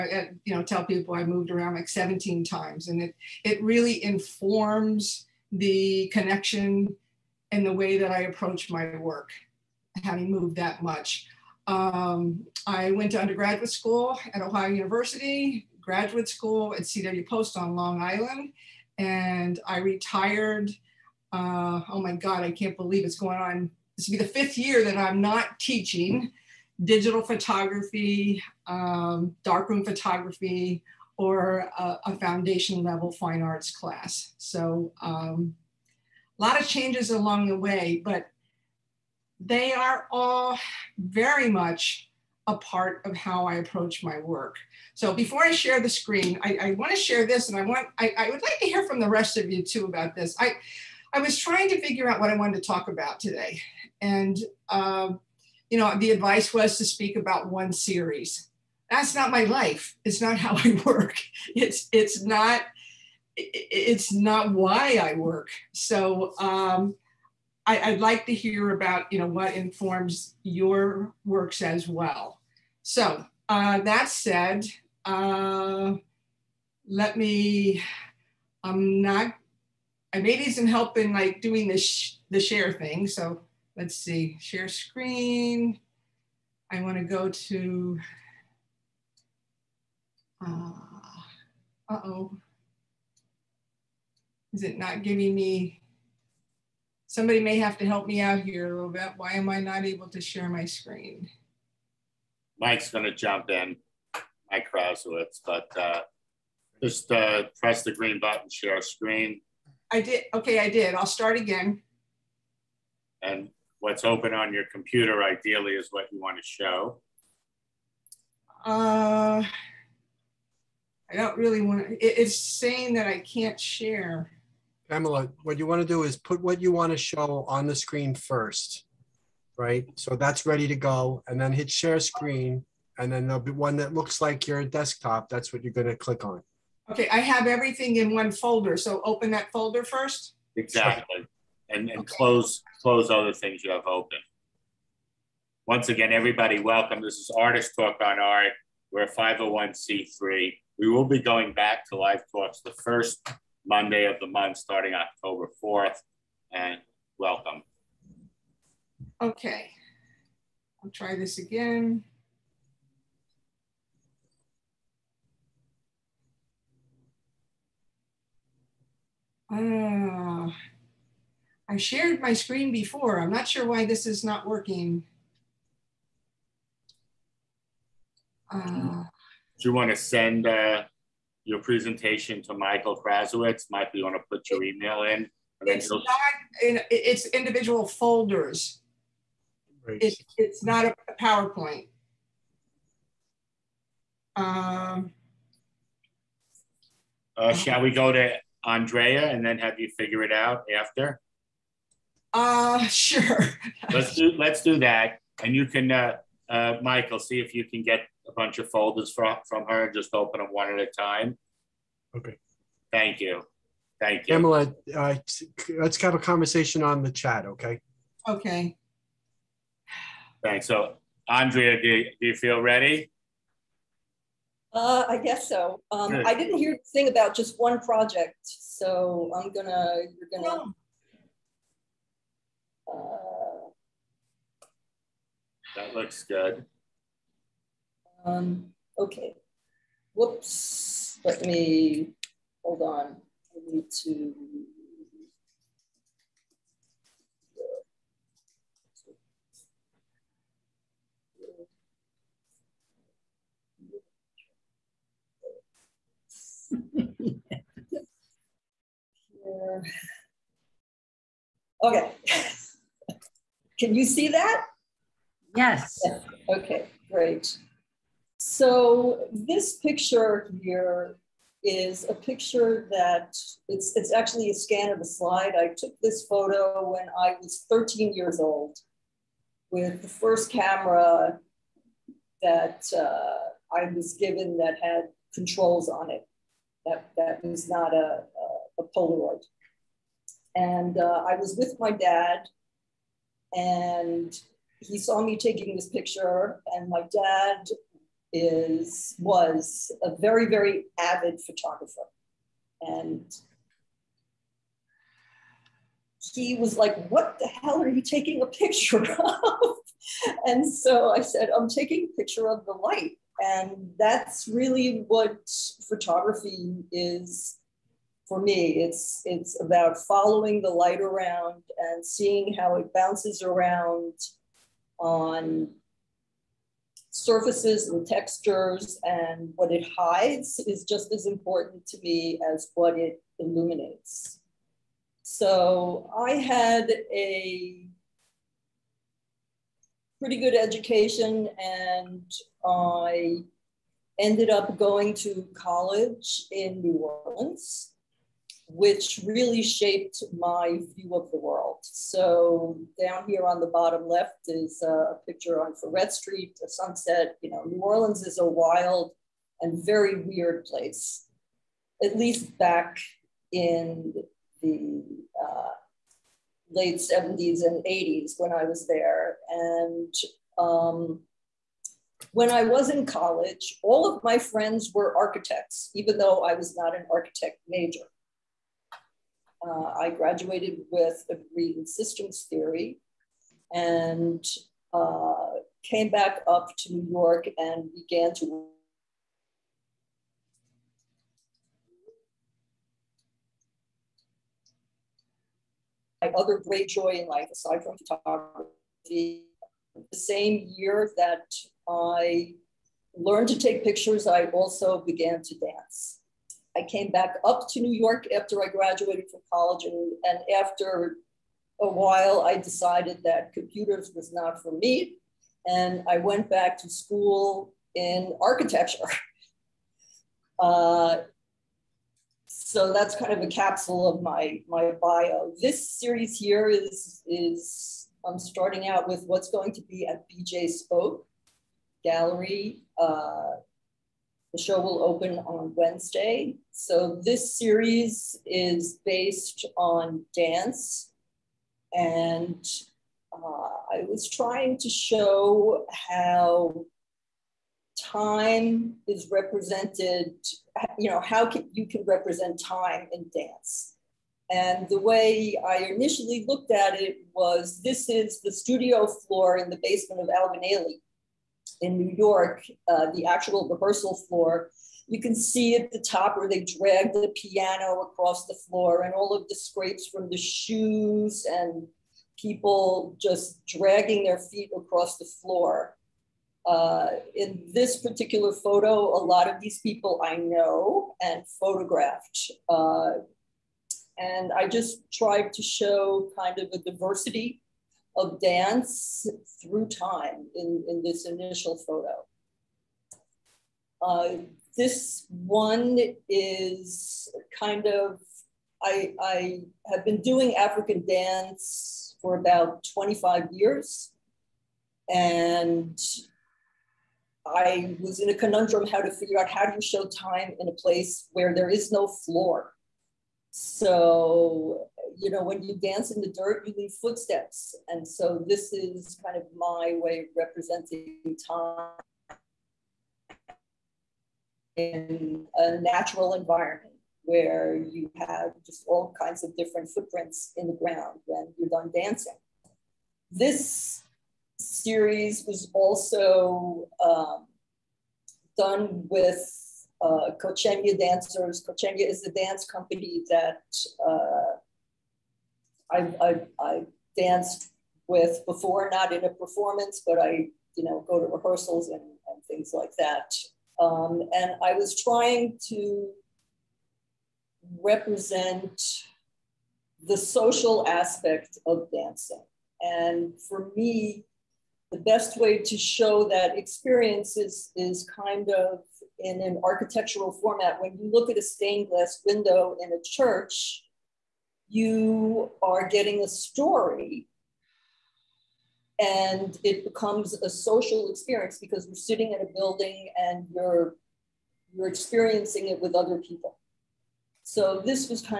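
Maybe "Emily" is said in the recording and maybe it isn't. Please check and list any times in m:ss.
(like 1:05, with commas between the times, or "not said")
3:34.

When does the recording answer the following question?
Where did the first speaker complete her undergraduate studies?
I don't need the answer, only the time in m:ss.
0:14.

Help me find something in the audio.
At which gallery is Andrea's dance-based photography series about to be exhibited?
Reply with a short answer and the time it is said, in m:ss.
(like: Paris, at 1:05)
BJ Spoke Gallery, at 7:10.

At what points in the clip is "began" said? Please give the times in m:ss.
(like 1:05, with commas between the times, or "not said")
6:27, 6:45.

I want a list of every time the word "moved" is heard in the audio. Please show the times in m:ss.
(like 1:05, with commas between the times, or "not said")
0:01, 0:10.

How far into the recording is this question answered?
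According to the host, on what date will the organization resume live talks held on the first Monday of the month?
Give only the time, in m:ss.
2:34.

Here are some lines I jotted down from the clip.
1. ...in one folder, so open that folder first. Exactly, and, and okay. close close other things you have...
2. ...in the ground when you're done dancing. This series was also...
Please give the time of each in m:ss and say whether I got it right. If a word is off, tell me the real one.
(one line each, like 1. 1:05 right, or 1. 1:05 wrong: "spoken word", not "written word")
1. 2:17 right
2. 8:50 right.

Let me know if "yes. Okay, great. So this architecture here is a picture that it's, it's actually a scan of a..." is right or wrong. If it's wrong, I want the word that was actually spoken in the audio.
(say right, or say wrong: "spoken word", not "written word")
wrong: "picture", not "architecture".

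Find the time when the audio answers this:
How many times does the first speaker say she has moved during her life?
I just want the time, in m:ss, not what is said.
0:01.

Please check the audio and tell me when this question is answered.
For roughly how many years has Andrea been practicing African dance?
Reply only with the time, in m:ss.
8:22.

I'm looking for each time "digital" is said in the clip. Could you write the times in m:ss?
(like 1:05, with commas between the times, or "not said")
0:26.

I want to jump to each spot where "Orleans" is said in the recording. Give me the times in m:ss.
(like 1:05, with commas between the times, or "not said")
5:46, 5:57.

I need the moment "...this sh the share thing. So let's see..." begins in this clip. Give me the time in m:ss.
1:21.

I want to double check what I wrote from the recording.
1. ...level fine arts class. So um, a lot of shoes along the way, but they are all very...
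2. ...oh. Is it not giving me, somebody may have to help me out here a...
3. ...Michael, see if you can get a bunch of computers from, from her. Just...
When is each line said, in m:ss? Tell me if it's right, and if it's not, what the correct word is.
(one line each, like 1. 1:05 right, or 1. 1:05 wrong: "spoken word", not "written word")
1. 0:32 wrong: "changes", not "shoes"
2. 1:31 right
3. 3:26 wrong: "folders", not "computers".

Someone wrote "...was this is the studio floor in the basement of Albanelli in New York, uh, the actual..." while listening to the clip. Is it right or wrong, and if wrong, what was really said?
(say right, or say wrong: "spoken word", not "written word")
right.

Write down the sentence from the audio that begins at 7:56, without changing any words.
Uh, in this particular photo, a lot of these people I know and photographed.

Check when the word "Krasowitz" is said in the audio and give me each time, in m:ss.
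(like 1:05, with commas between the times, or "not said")
1:44, 3:03.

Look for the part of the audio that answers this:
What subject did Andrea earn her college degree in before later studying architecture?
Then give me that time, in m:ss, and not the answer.
6:21.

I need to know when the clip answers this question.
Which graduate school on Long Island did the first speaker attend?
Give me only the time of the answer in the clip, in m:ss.
0:16.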